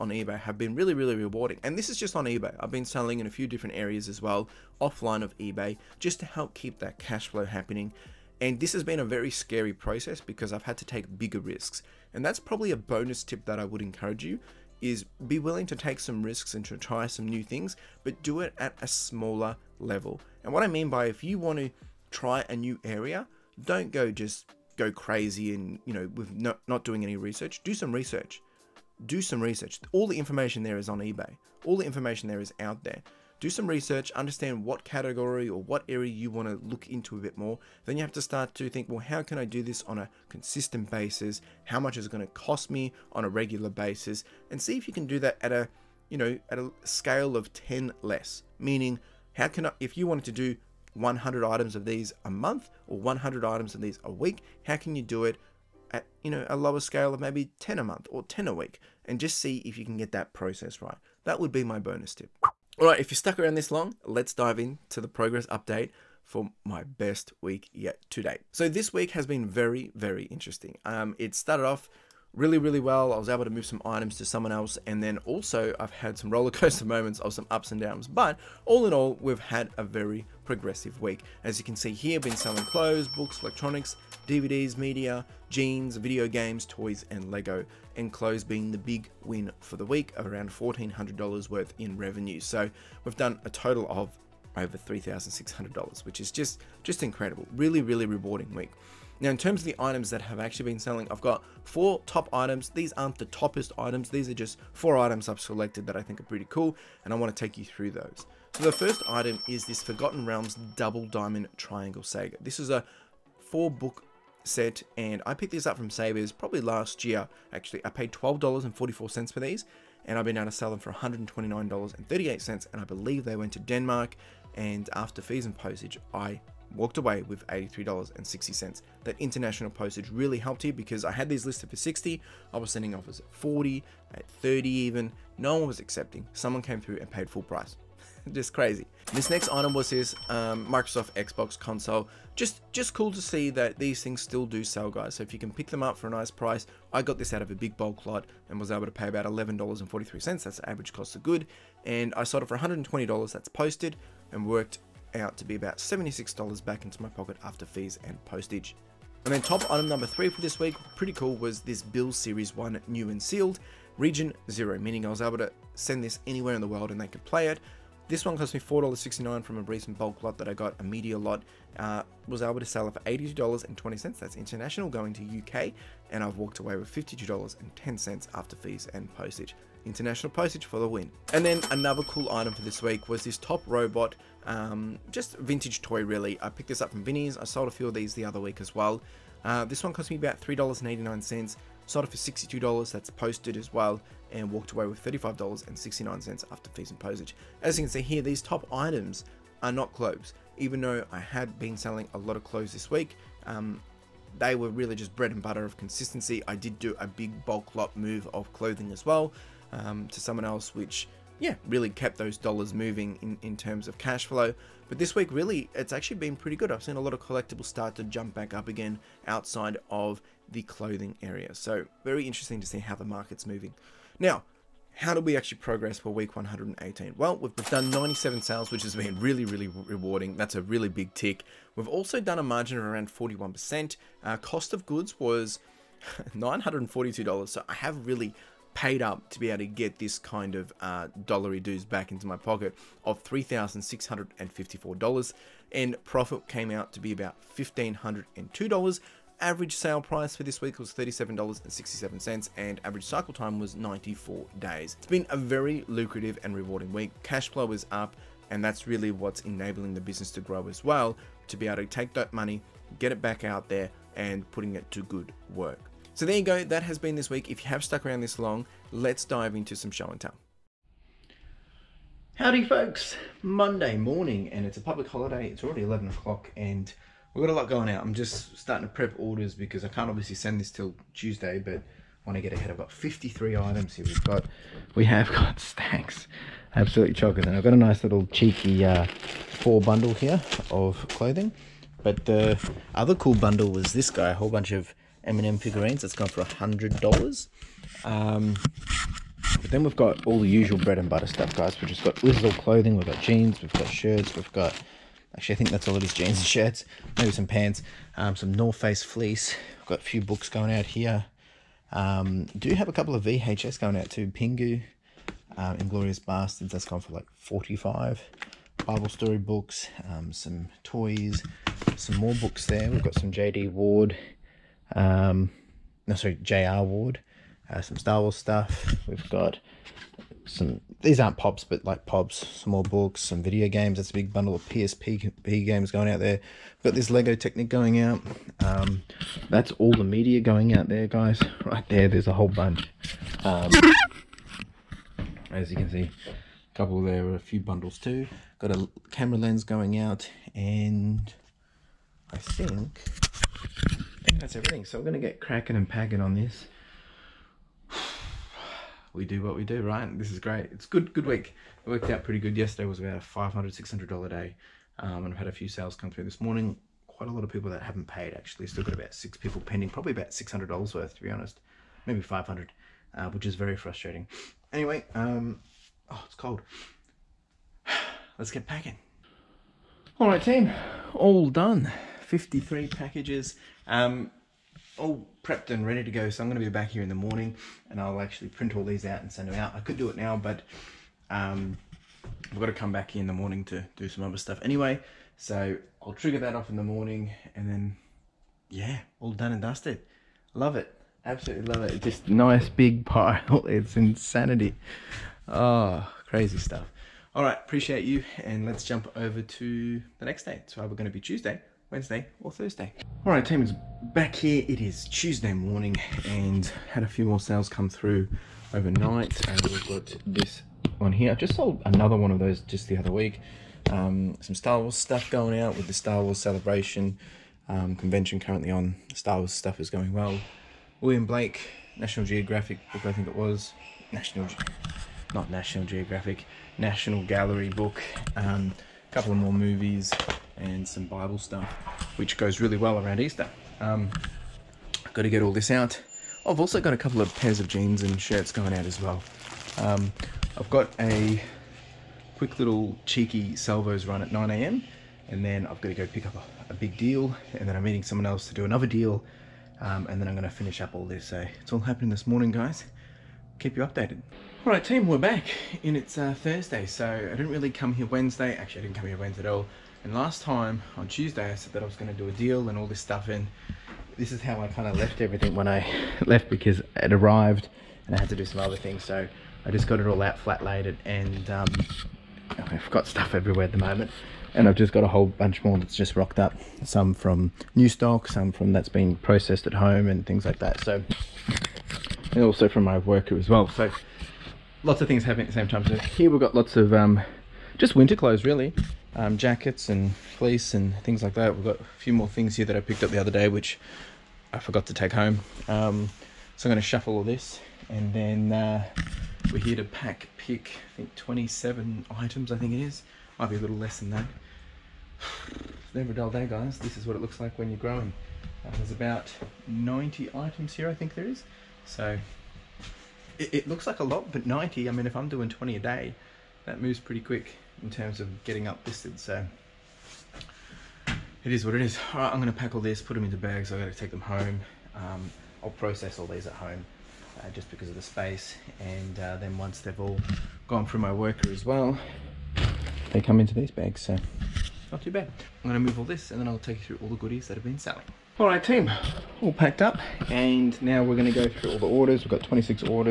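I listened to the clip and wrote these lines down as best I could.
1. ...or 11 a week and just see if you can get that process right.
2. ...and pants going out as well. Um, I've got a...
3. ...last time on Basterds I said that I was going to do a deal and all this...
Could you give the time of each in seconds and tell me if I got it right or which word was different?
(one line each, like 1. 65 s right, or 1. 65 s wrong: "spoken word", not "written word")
1. 58 s wrong: "10", not "11"
2. 448 s wrong: "shirts", not "pants"
3. 470 s wrong: "Tuesday", not "Basterds".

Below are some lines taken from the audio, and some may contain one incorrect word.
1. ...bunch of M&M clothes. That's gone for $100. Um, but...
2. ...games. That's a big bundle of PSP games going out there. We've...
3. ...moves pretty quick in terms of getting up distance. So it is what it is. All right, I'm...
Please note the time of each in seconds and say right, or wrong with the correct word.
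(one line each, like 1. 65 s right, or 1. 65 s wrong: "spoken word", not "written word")
1. 294 s wrong: "figurines", not "clothes"
2. 333 s right
3. 526 s right.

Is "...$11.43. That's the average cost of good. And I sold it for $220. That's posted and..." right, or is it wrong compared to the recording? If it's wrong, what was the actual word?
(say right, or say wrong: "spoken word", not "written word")
wrong: "120", not "220".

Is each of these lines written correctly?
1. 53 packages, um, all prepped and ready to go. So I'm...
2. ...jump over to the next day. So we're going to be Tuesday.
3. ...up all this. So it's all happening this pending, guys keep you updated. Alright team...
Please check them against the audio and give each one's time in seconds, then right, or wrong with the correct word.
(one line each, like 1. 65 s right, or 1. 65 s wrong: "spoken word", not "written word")
1. 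382 s right
2. 408 s right
3. 460 s wrong: "morning", not "pending".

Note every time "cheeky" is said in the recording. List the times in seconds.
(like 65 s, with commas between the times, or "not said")
288 s, 453 s.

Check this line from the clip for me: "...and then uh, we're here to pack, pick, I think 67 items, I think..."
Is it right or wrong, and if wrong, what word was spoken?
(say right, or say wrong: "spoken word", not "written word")
wrong: "27", not "67".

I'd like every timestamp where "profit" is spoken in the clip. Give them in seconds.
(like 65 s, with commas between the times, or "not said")
246 s.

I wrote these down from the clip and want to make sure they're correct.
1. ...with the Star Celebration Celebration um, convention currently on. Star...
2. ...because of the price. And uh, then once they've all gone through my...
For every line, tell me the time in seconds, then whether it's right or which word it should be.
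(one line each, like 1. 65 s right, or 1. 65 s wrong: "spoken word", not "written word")
1. 425 s wrong: "Wars", not "Celebration"
2. 537 s wrong: "space", not "price".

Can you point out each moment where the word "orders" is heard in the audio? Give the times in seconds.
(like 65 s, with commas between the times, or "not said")
279 s, 551 s.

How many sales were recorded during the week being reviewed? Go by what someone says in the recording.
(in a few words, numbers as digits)
97.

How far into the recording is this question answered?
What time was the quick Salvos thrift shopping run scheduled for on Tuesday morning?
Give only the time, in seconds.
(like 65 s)
454 s.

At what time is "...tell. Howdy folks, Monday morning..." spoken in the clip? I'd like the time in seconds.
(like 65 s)
270 s.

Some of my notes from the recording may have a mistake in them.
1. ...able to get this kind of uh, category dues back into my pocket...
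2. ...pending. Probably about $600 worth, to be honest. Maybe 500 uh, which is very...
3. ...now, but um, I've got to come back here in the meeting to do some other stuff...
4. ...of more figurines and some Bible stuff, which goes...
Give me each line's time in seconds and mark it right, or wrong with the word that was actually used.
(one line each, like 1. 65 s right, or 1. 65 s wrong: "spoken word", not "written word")
1. 239 s wrong: "dollary", not "category"
2. 369 s right
3. 390 s wrong: "morning", not "meeting"
4. 439 s wrong: "movies", not "figurines".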